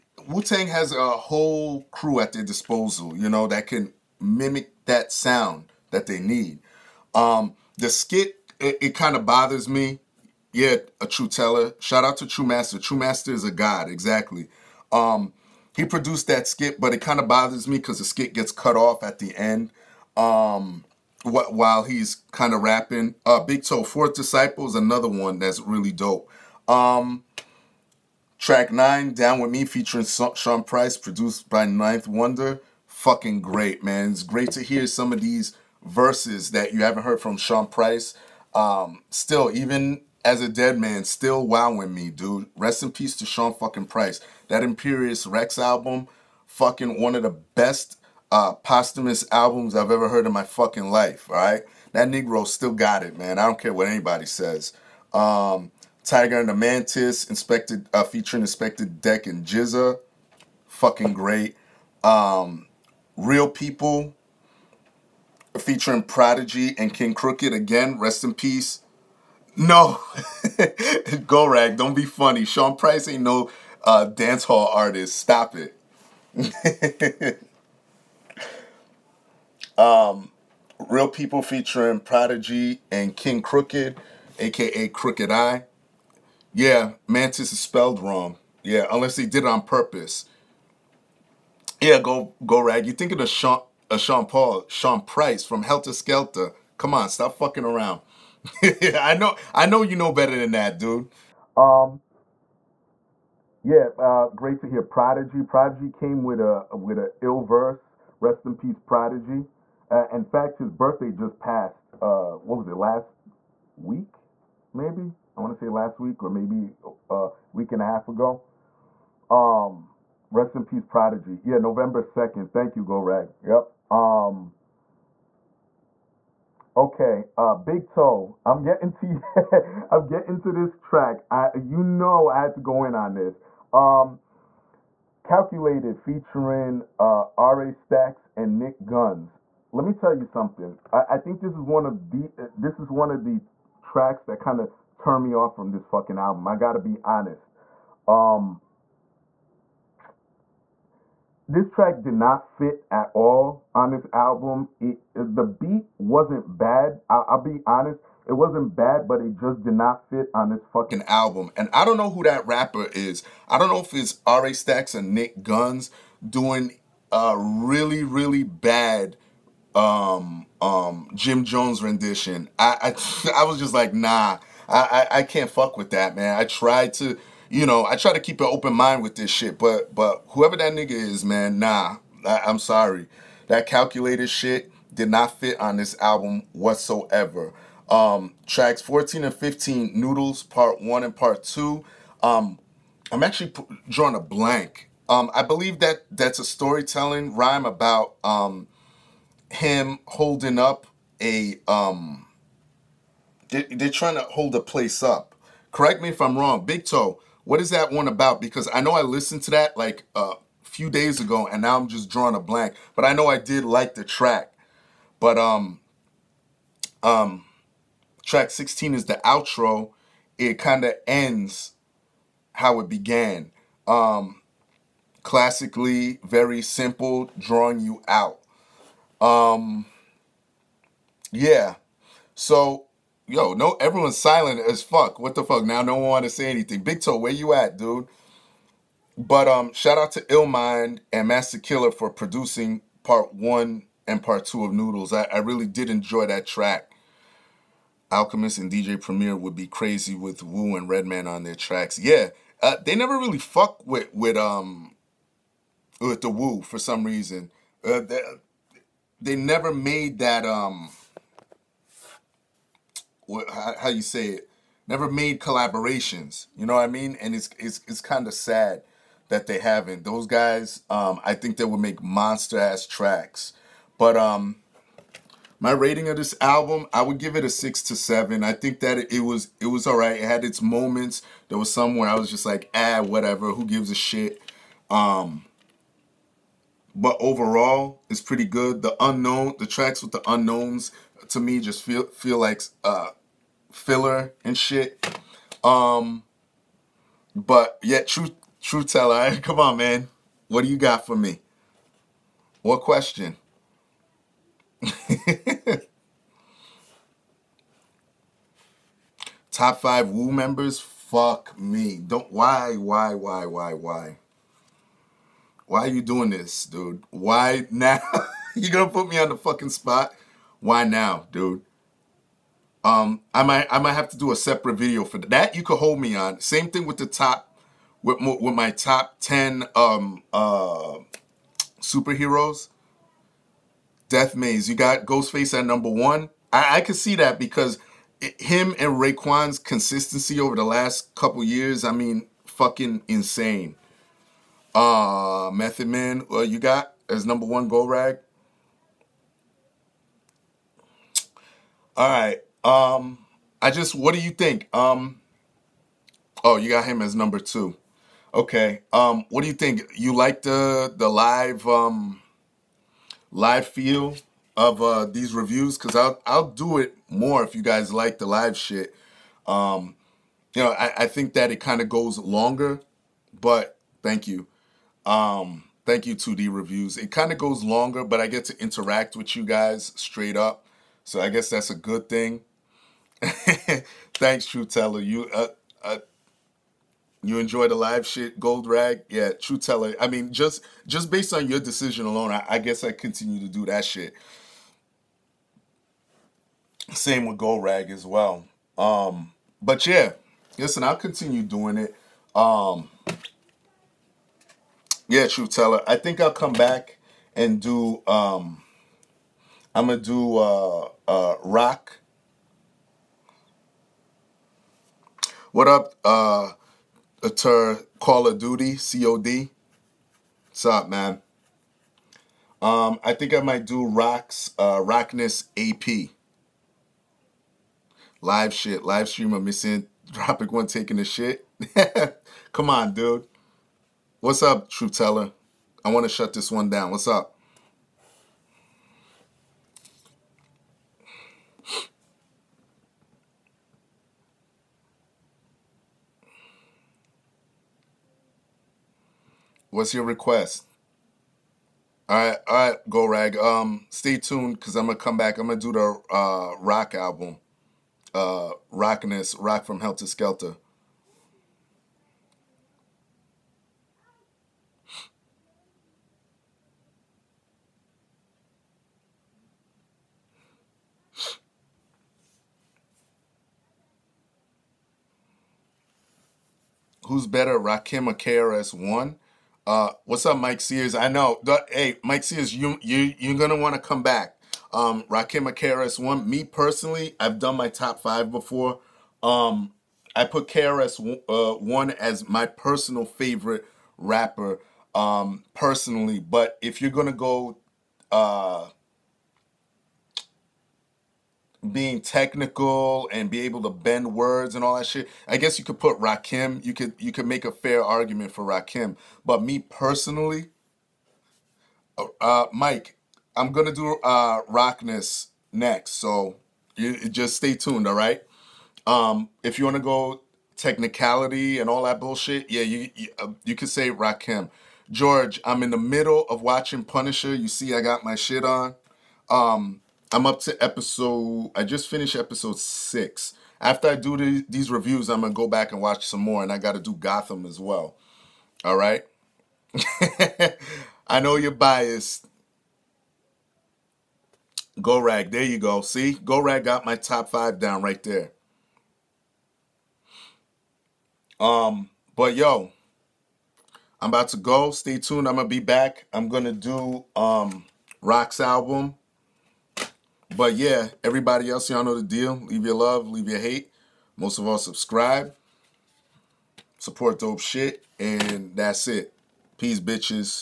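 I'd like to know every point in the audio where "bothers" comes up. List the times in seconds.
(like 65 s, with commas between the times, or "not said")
9 s, 17 s.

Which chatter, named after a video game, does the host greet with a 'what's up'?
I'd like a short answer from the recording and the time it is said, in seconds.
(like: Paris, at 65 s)
Call of Duty, at 417 s.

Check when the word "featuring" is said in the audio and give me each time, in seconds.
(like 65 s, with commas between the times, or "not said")
29 s, 58 s, 65 s, 81 s, 135 s.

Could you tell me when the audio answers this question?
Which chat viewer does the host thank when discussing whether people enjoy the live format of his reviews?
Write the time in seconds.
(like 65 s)
376 s.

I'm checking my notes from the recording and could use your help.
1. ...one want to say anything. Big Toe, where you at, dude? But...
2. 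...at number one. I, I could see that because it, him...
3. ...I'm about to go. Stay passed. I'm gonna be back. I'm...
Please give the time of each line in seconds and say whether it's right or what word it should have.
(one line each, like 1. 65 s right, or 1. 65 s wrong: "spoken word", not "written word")
1. 235 s right
2. 335 s right
3. 554 s wrong: "tuned", not "passed".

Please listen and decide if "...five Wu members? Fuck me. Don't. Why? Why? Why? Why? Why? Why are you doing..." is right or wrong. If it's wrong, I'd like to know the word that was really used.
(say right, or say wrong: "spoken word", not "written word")
right.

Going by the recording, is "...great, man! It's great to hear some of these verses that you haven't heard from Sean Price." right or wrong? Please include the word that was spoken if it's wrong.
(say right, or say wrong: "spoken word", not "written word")
right.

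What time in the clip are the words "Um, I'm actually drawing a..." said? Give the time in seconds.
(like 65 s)
192 s.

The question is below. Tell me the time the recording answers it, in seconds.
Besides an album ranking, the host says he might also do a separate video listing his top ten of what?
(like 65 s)
331 s.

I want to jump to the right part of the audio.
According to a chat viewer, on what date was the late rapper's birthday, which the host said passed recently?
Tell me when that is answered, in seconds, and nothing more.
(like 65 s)
121 s.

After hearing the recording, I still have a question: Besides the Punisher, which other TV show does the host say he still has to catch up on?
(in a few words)
Gotham.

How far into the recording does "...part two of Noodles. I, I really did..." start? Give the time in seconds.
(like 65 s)
244 s.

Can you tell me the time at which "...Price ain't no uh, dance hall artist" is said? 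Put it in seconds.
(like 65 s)
72 s.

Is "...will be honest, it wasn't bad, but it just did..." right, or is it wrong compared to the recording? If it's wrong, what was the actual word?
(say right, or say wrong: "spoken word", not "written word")
right.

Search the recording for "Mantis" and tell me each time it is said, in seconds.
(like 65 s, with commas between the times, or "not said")
56 s, 87 s.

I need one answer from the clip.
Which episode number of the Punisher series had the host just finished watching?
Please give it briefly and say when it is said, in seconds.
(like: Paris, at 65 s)
6, at 532 s.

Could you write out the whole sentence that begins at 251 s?
Yeah, uh, they never really fuck with with um with the Wu for some reason.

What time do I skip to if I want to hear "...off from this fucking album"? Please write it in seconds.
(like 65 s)
145 s.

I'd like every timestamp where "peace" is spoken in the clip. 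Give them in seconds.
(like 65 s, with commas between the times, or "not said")
42 s, 68 s, 108 s, 120 s, 569 s.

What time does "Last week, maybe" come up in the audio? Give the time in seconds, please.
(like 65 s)
112 s.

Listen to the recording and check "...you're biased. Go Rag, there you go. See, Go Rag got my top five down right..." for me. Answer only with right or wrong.
right.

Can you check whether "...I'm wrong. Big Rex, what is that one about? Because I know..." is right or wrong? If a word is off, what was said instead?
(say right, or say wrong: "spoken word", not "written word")
wrong: "Toe", not "Rex".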